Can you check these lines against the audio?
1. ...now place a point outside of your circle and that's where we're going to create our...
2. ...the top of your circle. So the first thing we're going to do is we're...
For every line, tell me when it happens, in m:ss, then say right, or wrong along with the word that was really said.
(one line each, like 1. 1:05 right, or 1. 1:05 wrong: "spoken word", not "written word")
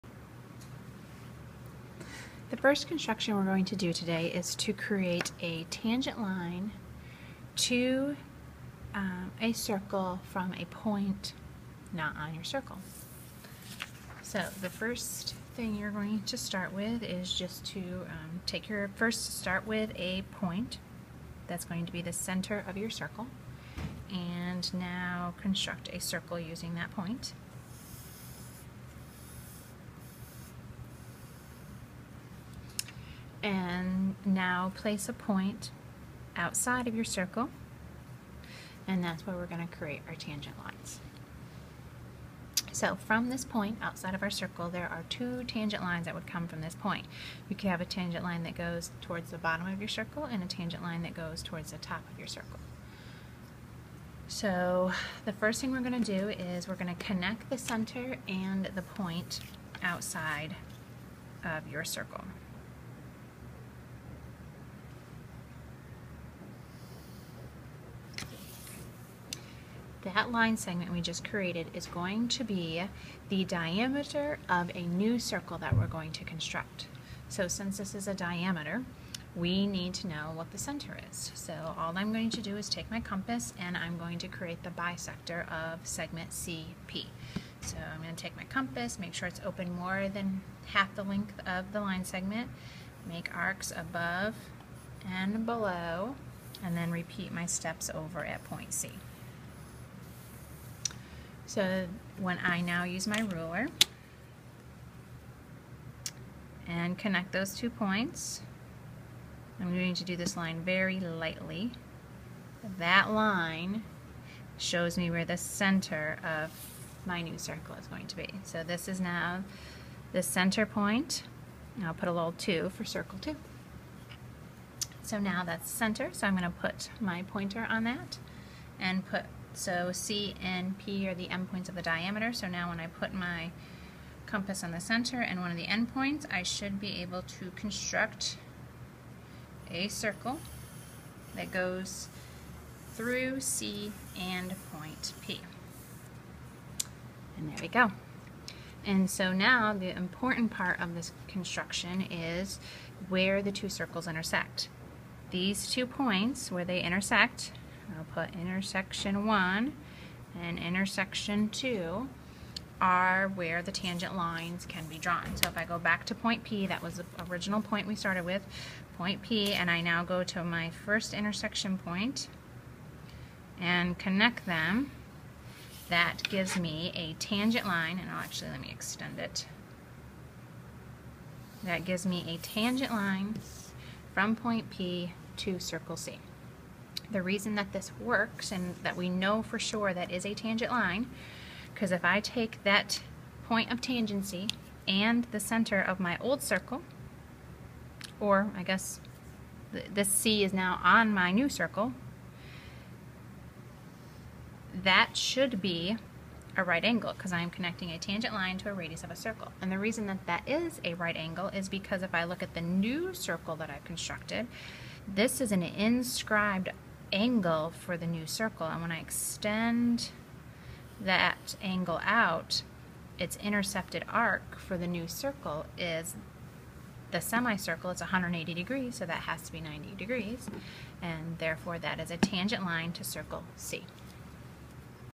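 1. 0:34 right
2. 0:51 right.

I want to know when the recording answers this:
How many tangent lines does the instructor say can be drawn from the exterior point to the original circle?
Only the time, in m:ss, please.
0:45.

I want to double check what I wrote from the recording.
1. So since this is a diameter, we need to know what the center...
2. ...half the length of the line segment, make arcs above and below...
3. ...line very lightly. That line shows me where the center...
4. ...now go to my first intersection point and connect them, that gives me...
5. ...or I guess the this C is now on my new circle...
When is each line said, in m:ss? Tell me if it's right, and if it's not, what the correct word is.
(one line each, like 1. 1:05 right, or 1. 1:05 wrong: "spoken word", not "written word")
1. 1:17 right
2. 1:30 right
3. 1:50 right
4. 2:49 right
5. 3:18 right.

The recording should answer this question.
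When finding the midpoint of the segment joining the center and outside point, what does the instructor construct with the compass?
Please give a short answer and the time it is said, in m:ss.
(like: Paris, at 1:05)
the bisector, at 1:24.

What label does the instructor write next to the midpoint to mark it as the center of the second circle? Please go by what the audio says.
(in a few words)
2.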